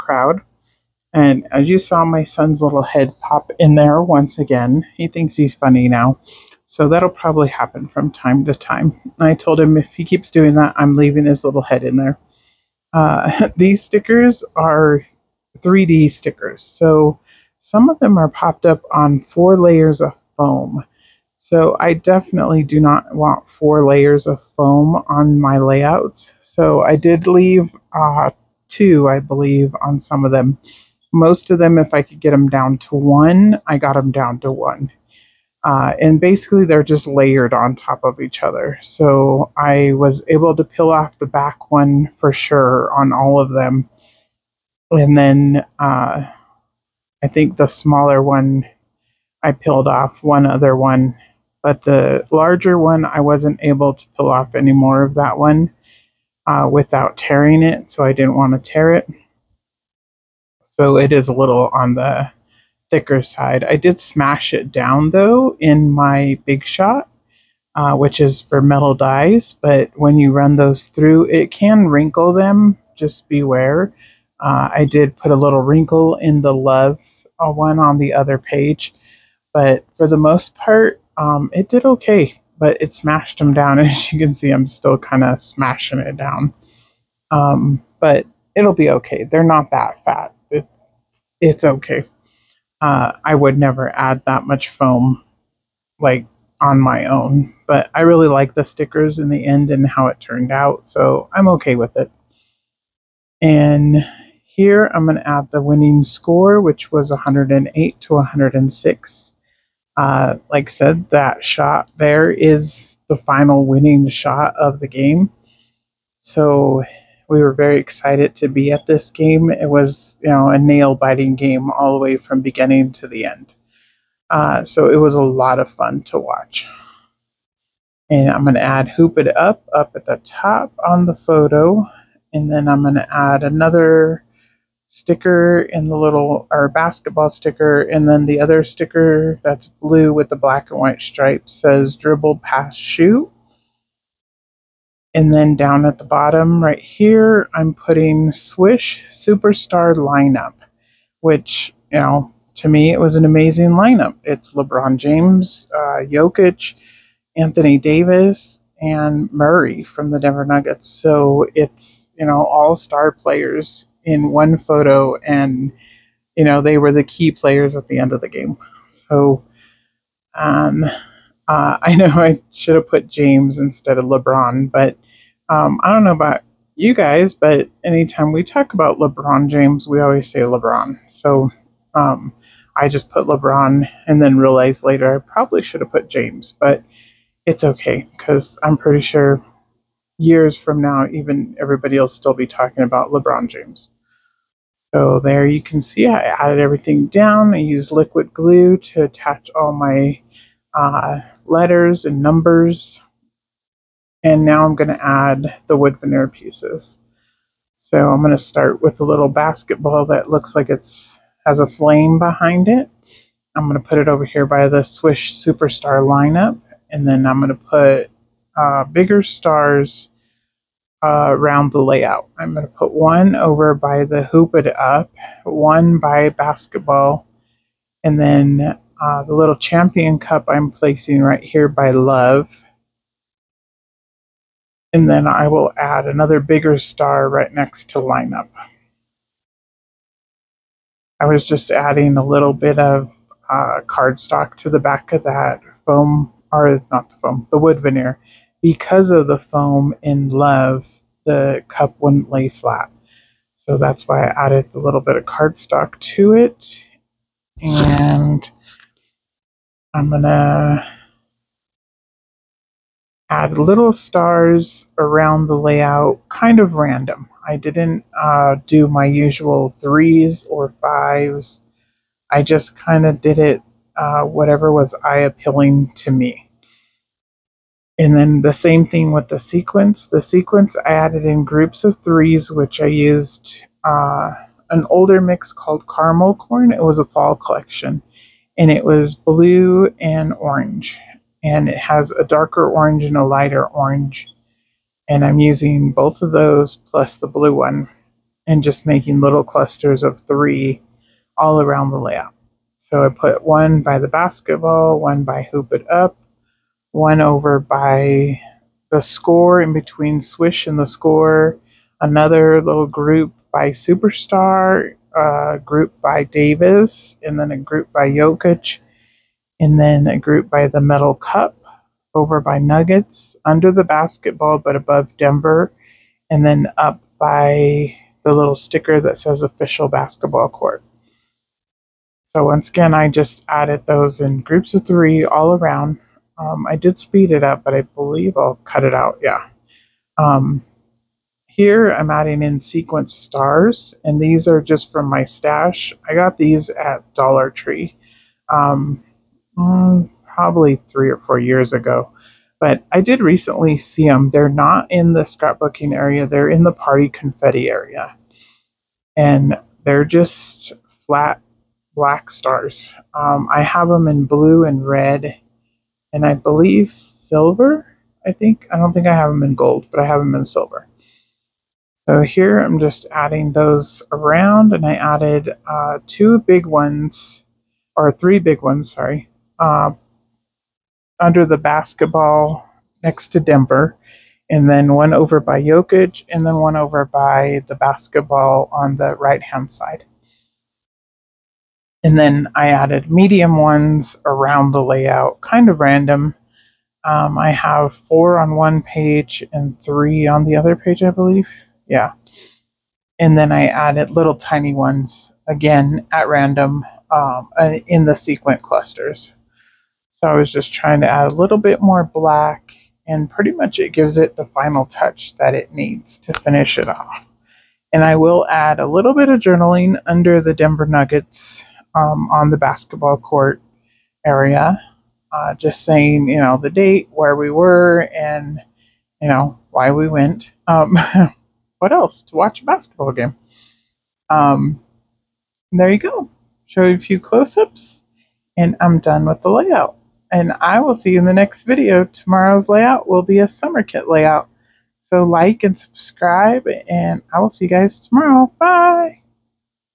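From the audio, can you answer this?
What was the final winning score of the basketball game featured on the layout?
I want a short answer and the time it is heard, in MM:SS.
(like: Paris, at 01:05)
108 to 106, at 01:47.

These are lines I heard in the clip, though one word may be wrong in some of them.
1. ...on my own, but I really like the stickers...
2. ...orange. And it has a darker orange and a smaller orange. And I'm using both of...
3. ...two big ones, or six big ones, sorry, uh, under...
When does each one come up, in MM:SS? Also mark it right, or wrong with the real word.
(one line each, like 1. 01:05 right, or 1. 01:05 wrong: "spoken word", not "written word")
1. 01:36 right
2. 04:50 wrong: "lighter", not "smaller"
3. 06:16 wrong: "three", not "six".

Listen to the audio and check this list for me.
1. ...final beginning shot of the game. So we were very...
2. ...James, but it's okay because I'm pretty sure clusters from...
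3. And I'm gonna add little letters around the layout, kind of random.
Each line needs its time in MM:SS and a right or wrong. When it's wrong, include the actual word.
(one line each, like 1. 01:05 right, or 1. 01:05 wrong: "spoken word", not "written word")
1. 01:53 wrong: "winning", not "beginning"
2. 03:06 wrong: "years", not "clusters"
3. 04:17 wrong: "stars", not "letters".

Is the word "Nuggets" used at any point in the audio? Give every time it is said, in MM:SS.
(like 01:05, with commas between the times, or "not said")
02:40, 05:22, 07:00.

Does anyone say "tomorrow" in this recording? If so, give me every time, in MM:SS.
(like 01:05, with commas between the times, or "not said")
07:22, 07:27.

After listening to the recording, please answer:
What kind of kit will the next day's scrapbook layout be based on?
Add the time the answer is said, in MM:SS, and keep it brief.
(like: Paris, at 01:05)
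summer kit, at 07:23.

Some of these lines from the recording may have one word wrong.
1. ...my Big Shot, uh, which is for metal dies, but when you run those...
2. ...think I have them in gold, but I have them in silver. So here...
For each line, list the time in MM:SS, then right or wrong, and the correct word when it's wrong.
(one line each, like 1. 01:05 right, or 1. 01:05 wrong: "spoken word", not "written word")
1. 01:05 right
2. 06:08 right.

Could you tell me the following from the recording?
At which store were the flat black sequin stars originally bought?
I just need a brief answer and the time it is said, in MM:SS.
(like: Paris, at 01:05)
Dollar Tree, at 05:47.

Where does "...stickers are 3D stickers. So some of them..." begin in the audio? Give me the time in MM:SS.
00:13.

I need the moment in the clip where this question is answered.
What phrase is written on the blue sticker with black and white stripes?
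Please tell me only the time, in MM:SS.
02:21.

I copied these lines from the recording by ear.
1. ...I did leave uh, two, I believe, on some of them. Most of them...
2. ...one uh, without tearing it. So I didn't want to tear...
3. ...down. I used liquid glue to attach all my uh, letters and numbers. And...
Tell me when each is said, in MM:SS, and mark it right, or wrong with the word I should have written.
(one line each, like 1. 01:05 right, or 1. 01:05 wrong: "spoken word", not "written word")
1. 00:26 right
2. 00:55 right
3. 03:17 right.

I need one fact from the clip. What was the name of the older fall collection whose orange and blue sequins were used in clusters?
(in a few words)
Caramel Corn.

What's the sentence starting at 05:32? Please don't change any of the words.
So once again, I just added those in groups of three all around.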